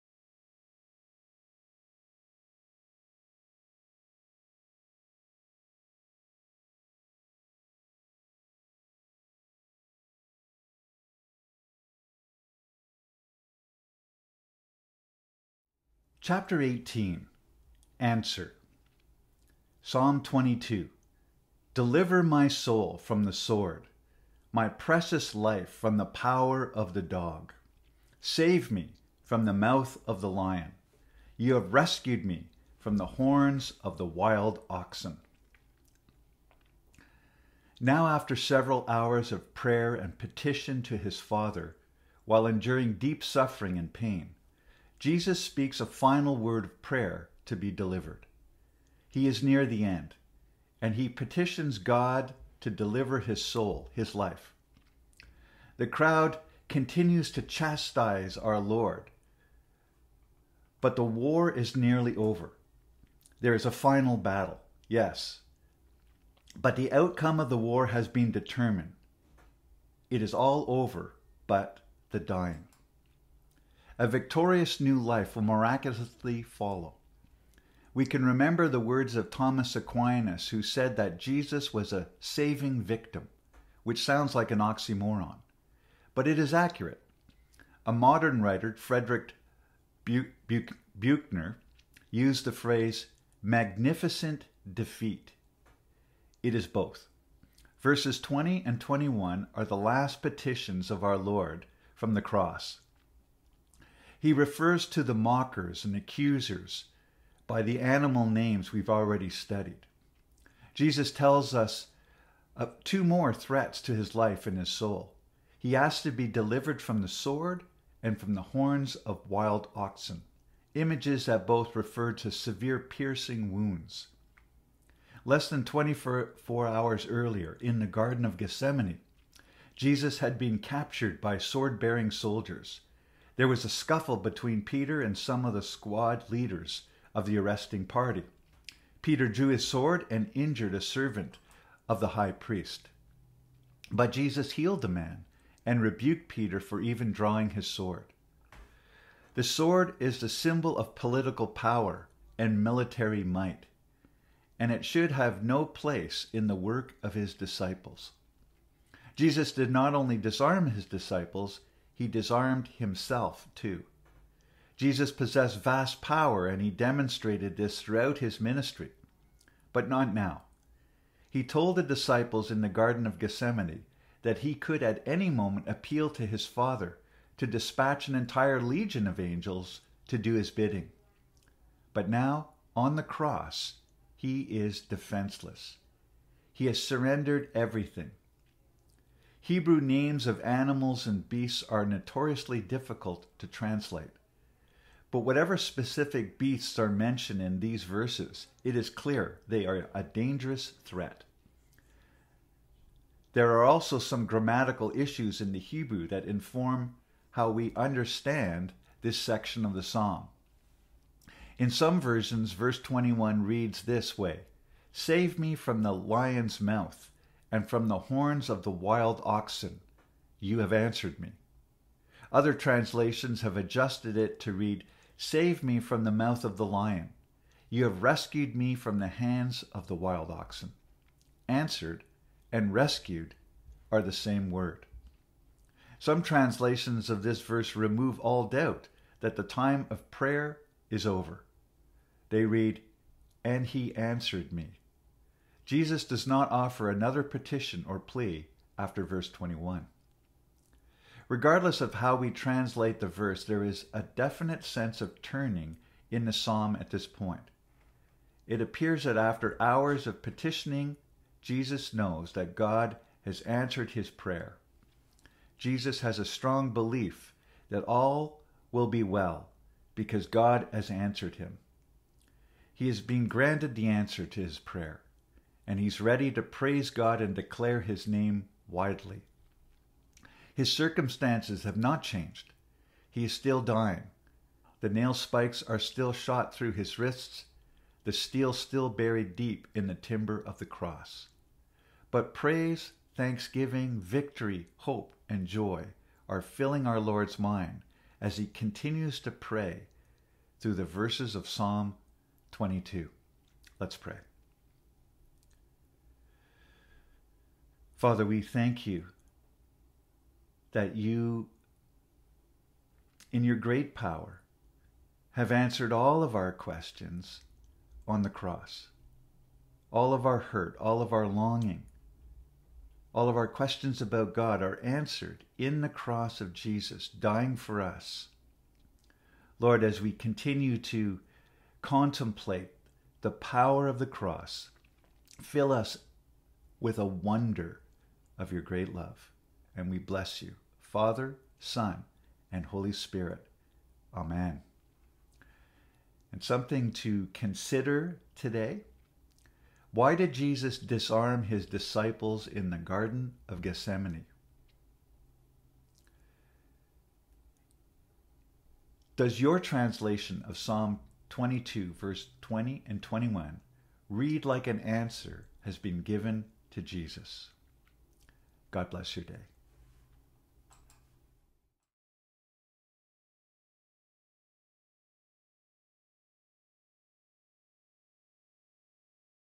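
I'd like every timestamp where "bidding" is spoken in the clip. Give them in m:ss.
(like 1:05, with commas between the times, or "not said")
3:00.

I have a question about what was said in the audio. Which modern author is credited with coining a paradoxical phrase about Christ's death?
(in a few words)
Frederick Buechner.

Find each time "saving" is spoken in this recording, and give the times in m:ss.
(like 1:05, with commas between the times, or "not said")
1:22.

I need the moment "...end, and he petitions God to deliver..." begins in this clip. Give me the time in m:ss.
0:49.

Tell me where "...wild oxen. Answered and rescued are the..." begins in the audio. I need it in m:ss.
3:49.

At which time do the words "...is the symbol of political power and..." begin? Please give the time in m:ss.
2:29.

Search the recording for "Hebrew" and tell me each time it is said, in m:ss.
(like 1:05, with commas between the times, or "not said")
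3:09, 3:25.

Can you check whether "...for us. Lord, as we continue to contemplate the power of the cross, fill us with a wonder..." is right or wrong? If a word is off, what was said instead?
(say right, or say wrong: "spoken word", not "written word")
right.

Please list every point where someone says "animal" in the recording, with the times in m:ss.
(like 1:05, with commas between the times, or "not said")
1:47, 3:10.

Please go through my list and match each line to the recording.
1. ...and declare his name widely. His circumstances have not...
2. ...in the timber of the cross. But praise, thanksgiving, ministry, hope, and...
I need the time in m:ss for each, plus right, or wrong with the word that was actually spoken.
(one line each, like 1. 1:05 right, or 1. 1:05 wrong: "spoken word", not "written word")
1. 4:37 right
2. 4:49 wrong: "victory", not "ministry".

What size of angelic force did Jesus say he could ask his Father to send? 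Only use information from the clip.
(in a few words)
an entire legion.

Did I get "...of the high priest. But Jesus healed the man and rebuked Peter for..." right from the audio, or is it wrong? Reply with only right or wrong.
right.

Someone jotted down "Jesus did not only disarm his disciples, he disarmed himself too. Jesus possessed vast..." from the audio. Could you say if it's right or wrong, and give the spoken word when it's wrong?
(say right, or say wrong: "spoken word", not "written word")
right.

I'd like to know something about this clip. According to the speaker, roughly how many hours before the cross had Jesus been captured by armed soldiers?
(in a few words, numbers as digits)
24.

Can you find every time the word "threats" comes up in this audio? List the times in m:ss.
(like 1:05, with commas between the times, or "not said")
1:53, 3:20.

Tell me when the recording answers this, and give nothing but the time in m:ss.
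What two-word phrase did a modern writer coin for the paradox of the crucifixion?
1:33.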